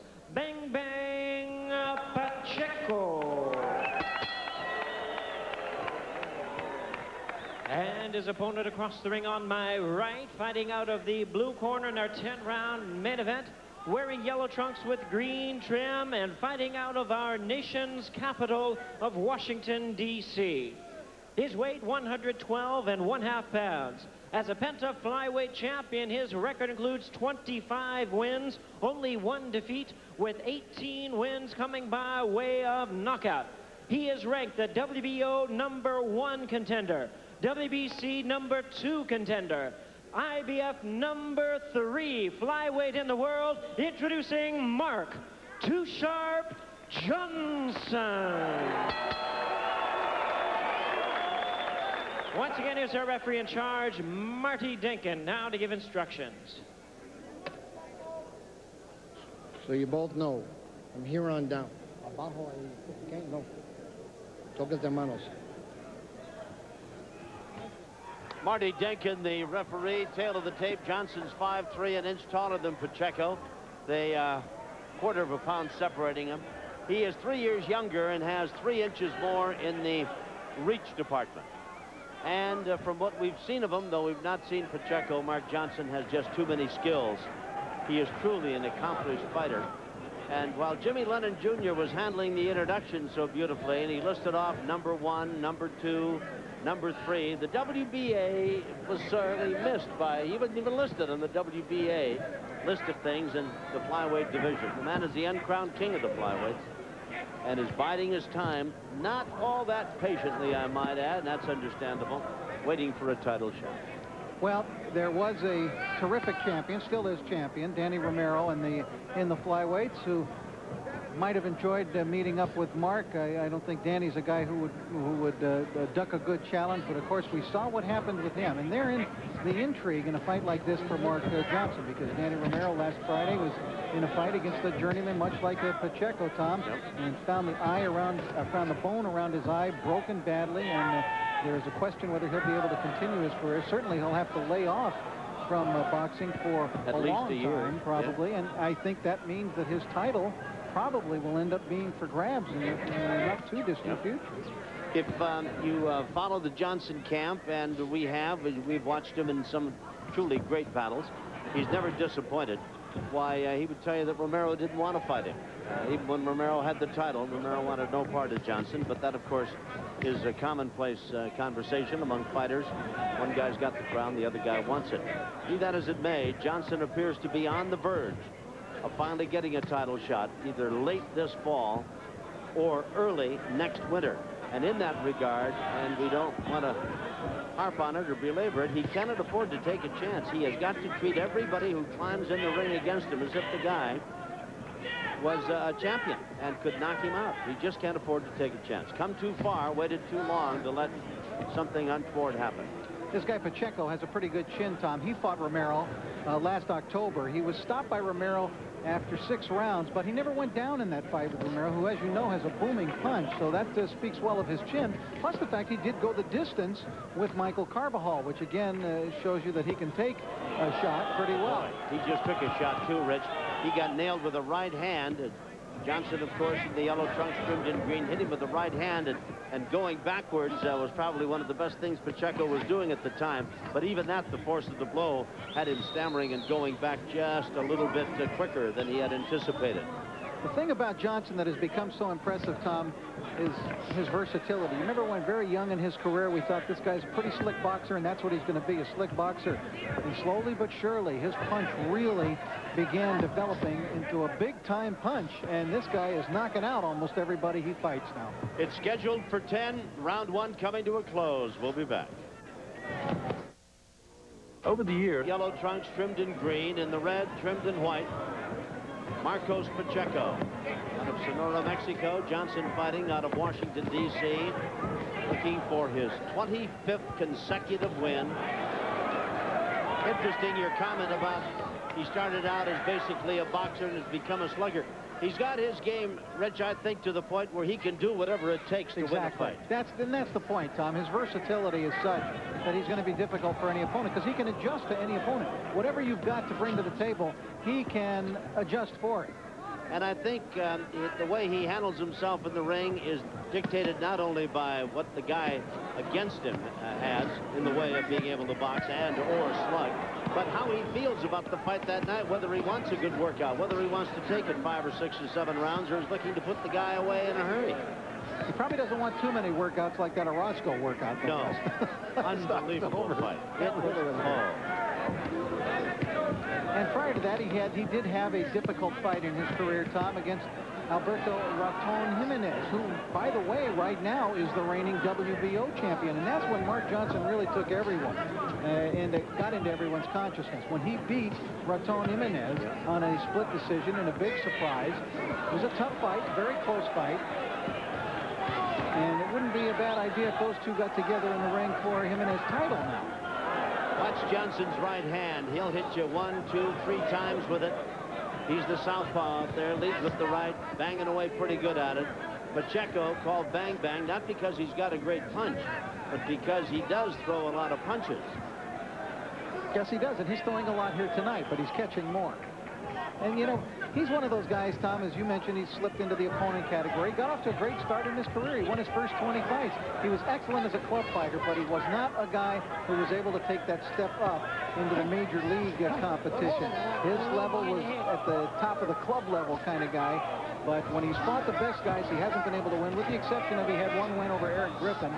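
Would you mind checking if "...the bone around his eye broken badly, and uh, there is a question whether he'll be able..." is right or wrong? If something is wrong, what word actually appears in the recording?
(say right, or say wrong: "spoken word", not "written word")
right.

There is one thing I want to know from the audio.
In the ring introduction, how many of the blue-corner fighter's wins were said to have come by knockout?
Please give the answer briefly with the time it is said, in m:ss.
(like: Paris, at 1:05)
18, at 0:30.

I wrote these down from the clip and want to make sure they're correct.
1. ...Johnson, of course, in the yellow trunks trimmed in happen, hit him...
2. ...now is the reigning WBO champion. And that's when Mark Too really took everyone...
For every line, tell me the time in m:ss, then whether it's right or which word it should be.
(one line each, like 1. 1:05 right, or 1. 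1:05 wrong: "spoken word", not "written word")
1. 3:45 wrong: "green", not "happen"
2. 5:34 wrong: "Johnson", not "Too".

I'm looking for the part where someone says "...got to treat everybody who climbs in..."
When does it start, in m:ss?
3:10.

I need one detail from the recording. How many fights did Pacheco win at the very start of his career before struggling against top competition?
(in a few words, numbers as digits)
20.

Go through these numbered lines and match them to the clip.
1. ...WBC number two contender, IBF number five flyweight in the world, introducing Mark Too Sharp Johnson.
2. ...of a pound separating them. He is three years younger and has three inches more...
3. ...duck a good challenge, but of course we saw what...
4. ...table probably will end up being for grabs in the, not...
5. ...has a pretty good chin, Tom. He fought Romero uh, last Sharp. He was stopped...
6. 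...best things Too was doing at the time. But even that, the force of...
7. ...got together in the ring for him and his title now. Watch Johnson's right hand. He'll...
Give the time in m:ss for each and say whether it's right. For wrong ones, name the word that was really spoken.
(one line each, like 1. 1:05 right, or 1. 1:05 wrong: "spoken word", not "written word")
1. 0:37 wrong: "three", not "five"
2. 1:15 right
3. 2:05 right
4. 2:29 wrong: "title", not "table"
5. 3:23 wrong: "October", not "Sharp"
6. 3:51 wrong: "Pacheco", not "Too"
7. 5:50 right.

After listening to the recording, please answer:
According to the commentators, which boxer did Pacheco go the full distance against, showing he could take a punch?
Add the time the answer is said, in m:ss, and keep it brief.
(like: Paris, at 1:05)
Michael Carbajal, at 3:37.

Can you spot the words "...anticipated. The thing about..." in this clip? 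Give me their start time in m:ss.
3:59.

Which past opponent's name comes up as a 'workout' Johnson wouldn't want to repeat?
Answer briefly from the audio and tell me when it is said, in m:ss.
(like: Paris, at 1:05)
Orozco, at 5:20.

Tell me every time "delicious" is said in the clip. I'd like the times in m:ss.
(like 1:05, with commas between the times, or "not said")
not said.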